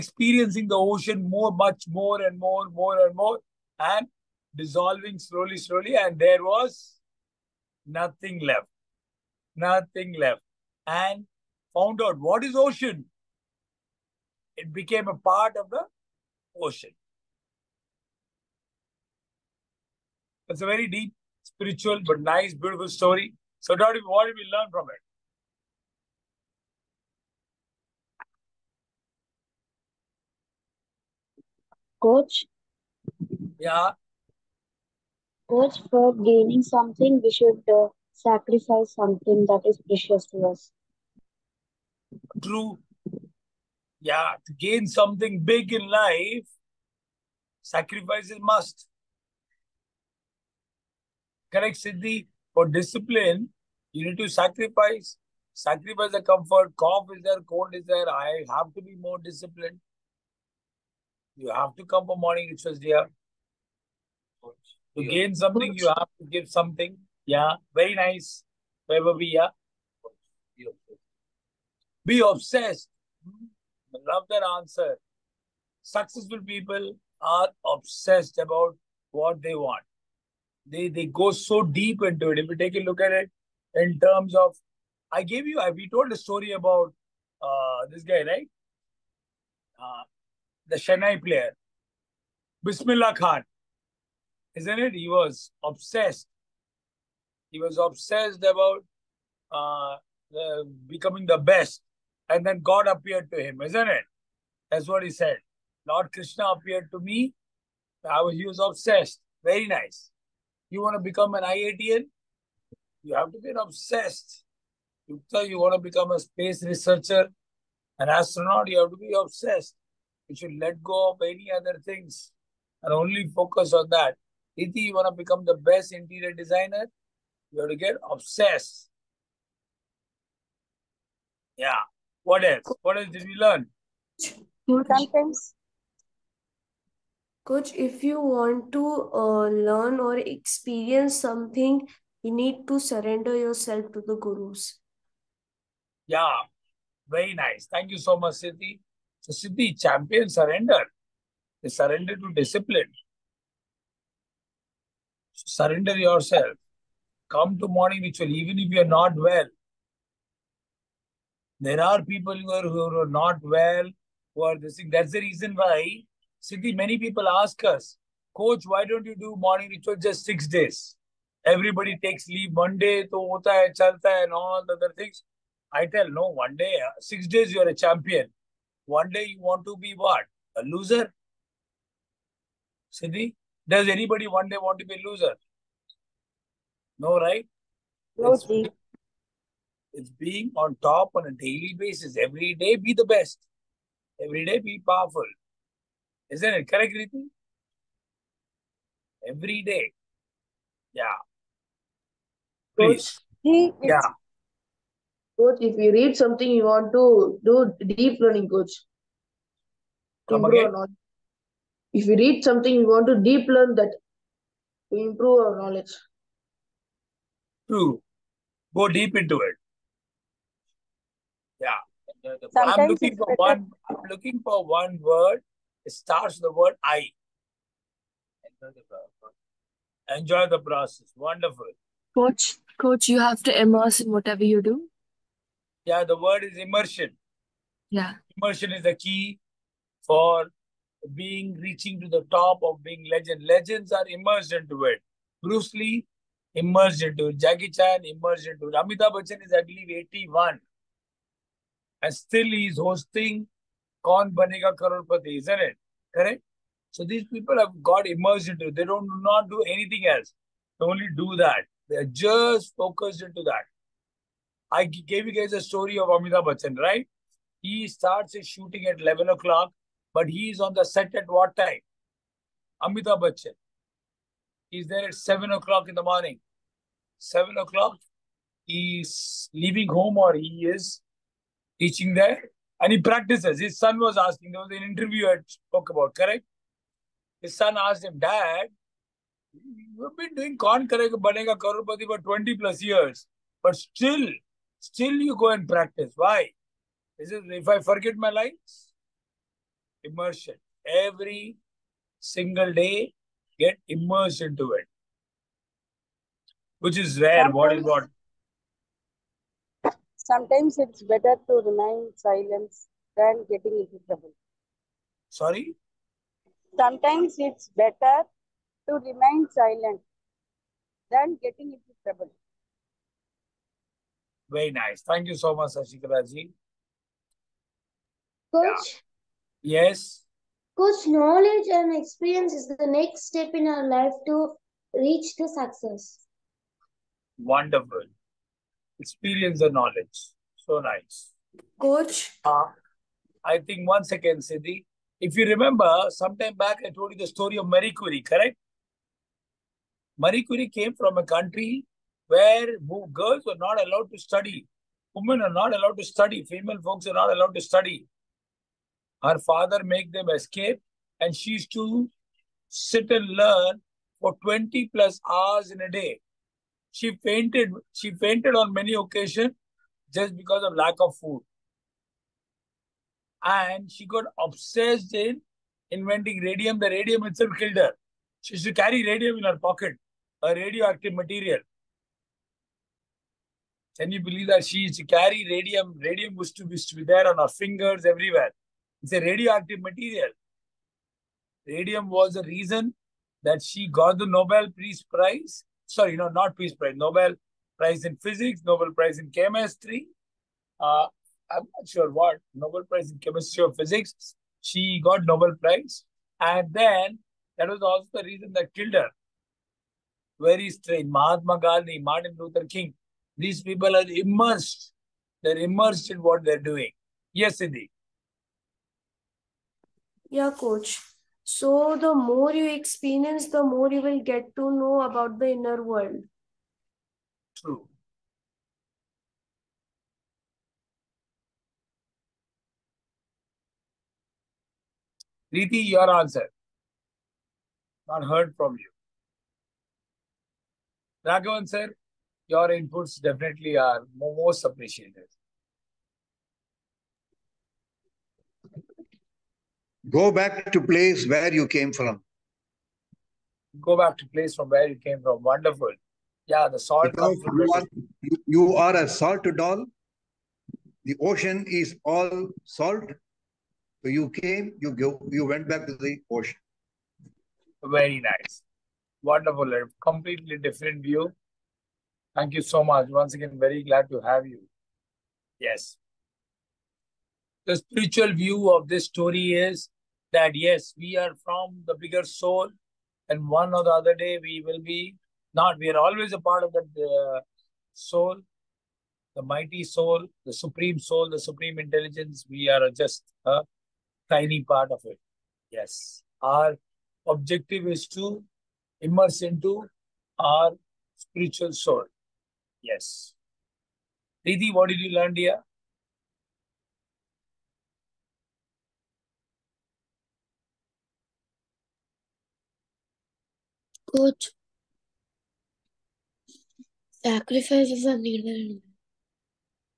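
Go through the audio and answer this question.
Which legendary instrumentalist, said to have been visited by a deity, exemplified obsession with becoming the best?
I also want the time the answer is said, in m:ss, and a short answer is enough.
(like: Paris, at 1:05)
Bismillah Khan, at 1:32.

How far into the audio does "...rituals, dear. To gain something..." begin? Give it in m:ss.
1:02.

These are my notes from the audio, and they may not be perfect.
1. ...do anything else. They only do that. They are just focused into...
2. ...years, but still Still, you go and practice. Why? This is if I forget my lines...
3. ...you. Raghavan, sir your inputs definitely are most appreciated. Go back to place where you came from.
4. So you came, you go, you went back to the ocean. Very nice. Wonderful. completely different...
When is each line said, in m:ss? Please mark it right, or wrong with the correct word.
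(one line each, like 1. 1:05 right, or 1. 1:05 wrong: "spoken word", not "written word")
1. 4:19 right
2. 4:52 right
3. 7:18 right
4. 7:44 right.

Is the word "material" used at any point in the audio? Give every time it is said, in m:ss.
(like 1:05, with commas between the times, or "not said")
6:21, 6:29.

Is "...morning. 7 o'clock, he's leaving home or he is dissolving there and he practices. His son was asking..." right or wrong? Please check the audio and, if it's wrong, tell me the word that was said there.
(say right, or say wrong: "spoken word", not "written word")
wrong: "teaching", not "dissolving".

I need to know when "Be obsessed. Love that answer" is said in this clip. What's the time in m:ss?
1:12.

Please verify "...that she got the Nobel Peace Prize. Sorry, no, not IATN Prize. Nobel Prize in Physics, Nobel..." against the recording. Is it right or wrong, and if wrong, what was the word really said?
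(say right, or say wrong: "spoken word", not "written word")
wrong: "Peace", not "IATN".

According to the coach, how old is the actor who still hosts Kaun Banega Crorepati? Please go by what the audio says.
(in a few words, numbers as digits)
81.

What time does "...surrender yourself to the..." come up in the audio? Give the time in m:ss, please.
2:22.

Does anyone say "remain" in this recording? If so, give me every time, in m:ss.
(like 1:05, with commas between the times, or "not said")
5:11, 5:19.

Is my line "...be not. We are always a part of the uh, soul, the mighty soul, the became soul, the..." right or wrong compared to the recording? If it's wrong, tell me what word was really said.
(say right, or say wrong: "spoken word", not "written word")
wrong: "supreme", not "became".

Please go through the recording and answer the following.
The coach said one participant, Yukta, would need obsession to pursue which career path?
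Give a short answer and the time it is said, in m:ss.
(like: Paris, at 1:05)
space researcher, at 1:56.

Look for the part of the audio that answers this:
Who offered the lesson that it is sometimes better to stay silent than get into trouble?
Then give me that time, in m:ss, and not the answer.
5:25.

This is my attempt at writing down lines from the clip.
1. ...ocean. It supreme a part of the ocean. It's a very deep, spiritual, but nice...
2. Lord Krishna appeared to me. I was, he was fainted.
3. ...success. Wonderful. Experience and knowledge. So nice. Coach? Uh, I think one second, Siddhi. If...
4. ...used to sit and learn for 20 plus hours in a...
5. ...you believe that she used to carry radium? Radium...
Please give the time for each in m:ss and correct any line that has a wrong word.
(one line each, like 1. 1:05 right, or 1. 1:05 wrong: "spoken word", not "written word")
1. 0:12 wrong: "became", not "supreme"
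2. 1:45 wrong: "obsessed", not "fainted"
3. 5:35 right
4. 6:01 right
5. 6:24 right.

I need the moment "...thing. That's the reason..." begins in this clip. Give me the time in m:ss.
2:44.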